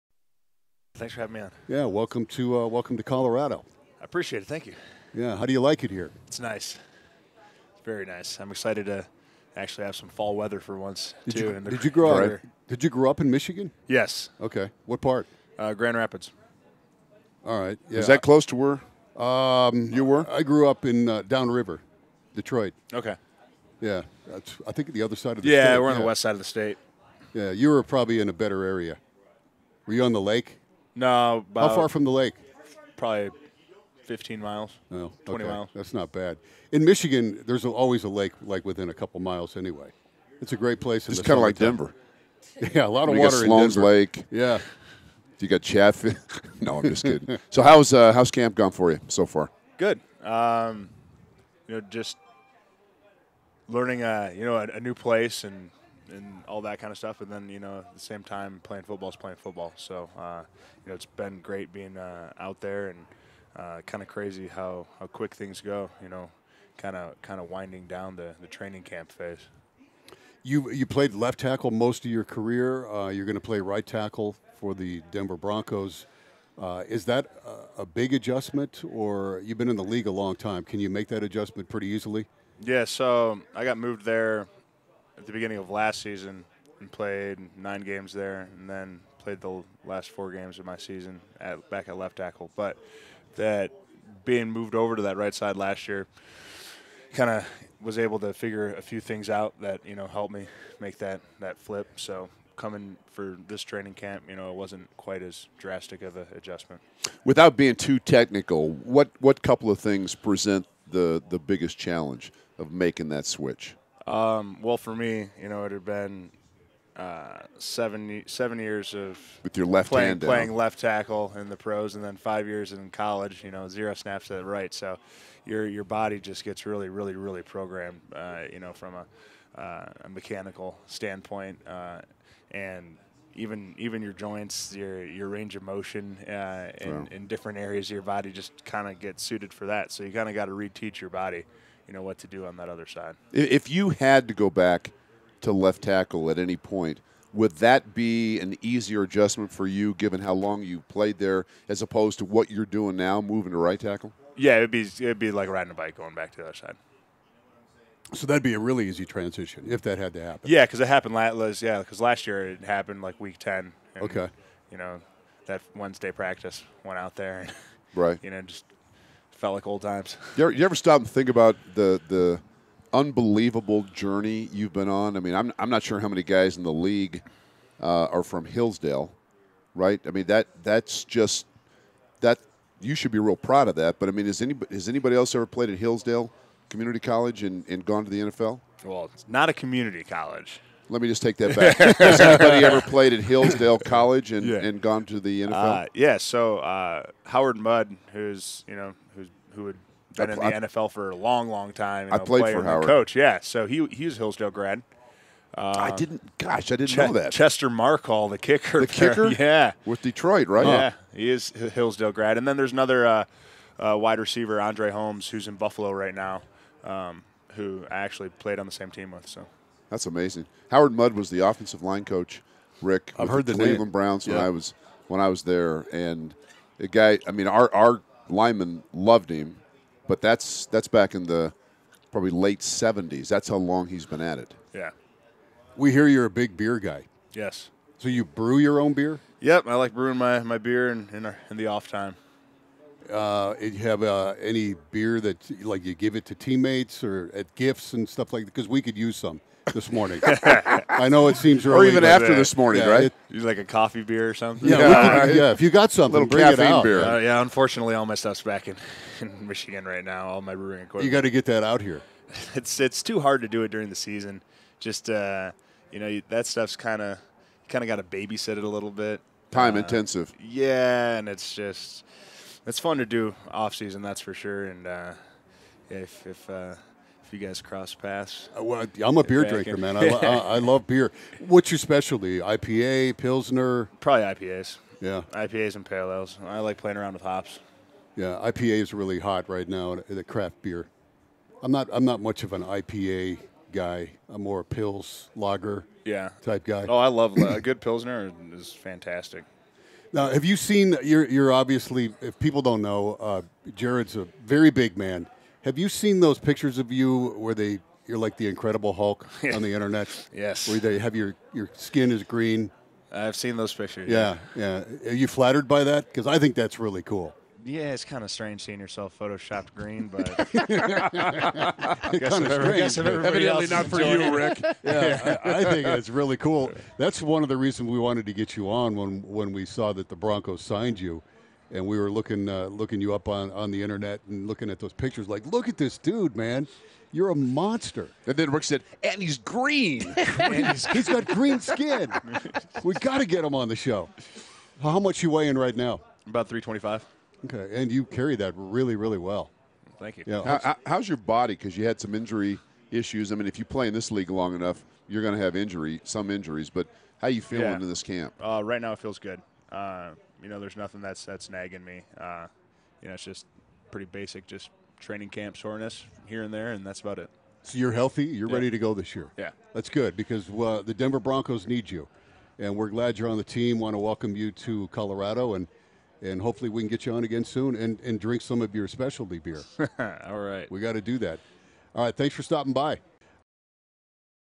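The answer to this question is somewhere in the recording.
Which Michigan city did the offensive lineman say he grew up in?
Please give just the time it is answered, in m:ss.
0:15.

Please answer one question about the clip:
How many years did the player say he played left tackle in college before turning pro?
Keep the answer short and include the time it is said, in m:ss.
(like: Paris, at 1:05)
5, at 2:02.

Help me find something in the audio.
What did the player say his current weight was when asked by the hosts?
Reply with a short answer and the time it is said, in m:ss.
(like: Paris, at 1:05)
325, at 5:46.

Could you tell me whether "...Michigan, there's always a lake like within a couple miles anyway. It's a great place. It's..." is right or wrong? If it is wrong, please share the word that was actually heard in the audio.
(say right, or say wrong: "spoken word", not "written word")
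right.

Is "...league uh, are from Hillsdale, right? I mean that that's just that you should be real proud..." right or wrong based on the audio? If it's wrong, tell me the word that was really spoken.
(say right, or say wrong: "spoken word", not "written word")
right.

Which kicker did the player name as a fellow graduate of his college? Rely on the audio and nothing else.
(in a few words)
Chester Marcol.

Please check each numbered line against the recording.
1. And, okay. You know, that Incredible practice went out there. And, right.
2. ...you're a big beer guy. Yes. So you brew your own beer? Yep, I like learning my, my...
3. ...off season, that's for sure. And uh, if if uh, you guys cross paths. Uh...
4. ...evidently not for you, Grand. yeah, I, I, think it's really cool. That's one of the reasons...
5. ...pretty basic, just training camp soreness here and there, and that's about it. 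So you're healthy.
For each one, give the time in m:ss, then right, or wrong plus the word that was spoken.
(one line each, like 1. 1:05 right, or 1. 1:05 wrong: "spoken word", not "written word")
1. 2:43 wrong: "Wednesday", not "Incredible"
2. 3:56 wrong: "brewing", not "learning"
3. 4:33 right
4. 5:22 wrong: "Rick", not "Grand"
5. 6:03 right.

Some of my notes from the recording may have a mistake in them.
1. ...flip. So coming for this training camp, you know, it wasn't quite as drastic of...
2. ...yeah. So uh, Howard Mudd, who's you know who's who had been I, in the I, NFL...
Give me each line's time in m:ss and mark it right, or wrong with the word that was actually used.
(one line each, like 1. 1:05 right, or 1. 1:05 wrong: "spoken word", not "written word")
1. 1:41 right
2. 3:15 right.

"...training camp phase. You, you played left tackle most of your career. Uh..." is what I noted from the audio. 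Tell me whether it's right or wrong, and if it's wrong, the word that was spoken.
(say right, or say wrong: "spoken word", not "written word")
right.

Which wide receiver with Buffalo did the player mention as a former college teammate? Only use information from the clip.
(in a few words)
Andre Holmes.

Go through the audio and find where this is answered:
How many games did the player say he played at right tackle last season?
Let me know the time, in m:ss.
1:27.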